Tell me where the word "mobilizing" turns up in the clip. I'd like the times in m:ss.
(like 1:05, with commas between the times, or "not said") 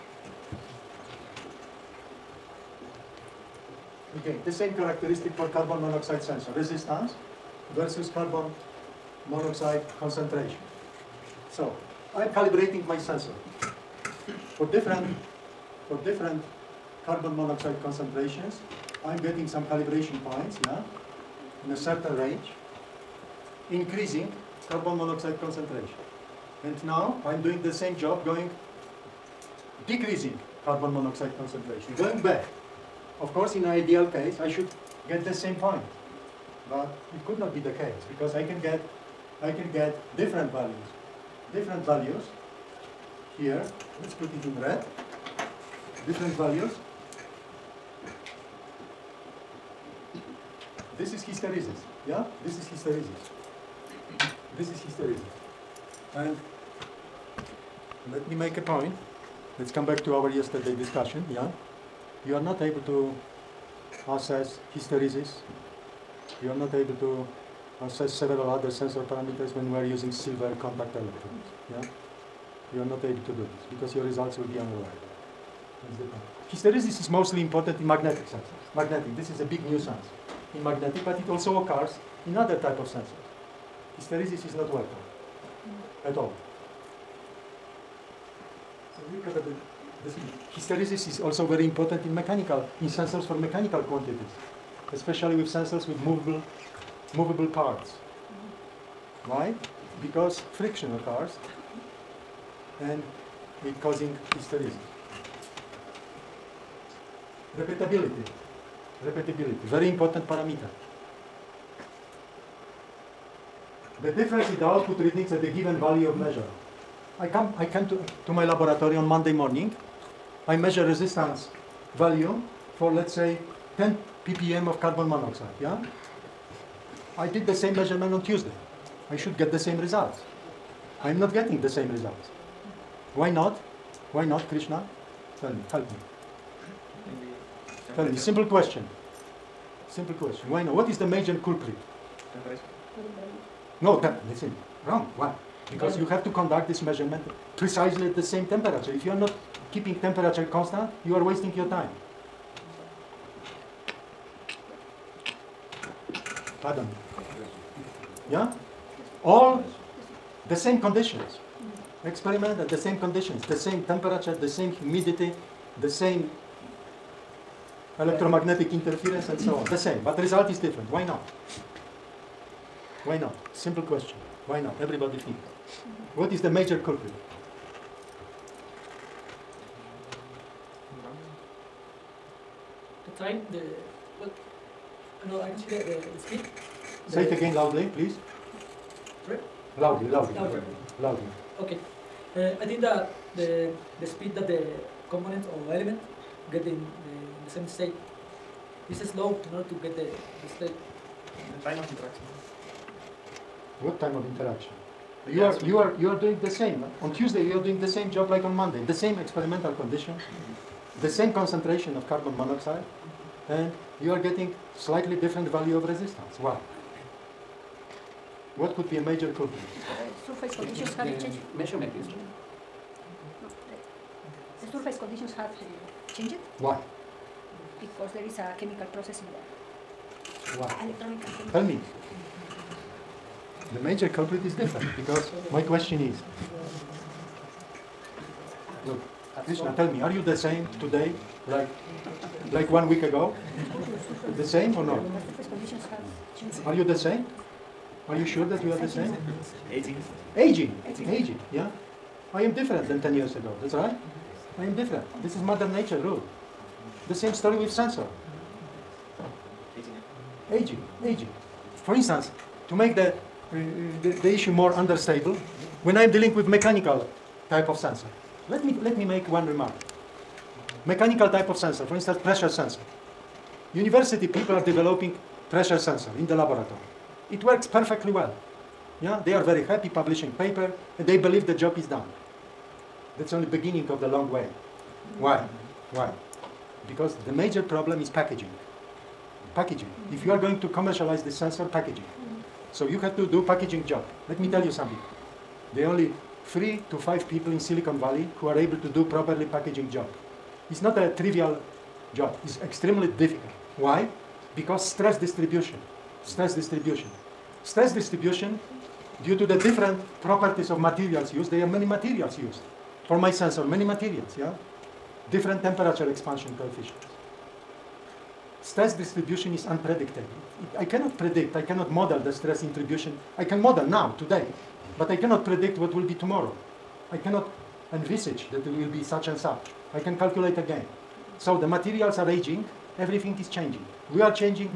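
not said.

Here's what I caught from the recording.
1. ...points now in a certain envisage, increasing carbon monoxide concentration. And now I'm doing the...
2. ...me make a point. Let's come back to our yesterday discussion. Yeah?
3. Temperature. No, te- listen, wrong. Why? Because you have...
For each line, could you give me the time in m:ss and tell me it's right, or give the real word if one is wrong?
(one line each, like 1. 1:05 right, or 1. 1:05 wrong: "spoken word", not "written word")
1. 0:20 wrong: "range", not "envisage"
2. 0:58 right
3. 2:22 right.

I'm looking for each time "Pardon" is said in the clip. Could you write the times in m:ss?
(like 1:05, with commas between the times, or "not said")
2:36.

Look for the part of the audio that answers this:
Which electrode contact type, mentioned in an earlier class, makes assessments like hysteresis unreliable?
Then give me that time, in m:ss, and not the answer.
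1:10.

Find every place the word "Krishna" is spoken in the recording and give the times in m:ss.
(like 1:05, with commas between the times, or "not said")
2:14, 3:59.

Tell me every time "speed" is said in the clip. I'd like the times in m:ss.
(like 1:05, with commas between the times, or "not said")
3:06, 3:14.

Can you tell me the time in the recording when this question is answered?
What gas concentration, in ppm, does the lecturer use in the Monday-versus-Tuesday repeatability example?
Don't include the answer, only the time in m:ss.
2:03.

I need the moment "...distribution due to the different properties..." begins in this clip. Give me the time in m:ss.
5:07.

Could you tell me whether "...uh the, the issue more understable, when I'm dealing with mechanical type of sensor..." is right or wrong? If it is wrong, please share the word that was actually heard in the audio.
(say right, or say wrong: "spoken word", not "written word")
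right.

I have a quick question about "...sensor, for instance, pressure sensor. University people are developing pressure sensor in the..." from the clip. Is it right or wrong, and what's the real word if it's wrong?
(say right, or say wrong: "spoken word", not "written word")
right.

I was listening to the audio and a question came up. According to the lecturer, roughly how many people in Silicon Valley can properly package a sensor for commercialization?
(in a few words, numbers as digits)
3 to 5.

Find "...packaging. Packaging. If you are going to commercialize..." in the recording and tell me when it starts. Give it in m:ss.
4:48.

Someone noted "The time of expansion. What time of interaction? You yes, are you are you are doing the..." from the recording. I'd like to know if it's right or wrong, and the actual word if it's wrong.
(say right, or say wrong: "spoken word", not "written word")
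wrong: "interaction", not "expansion".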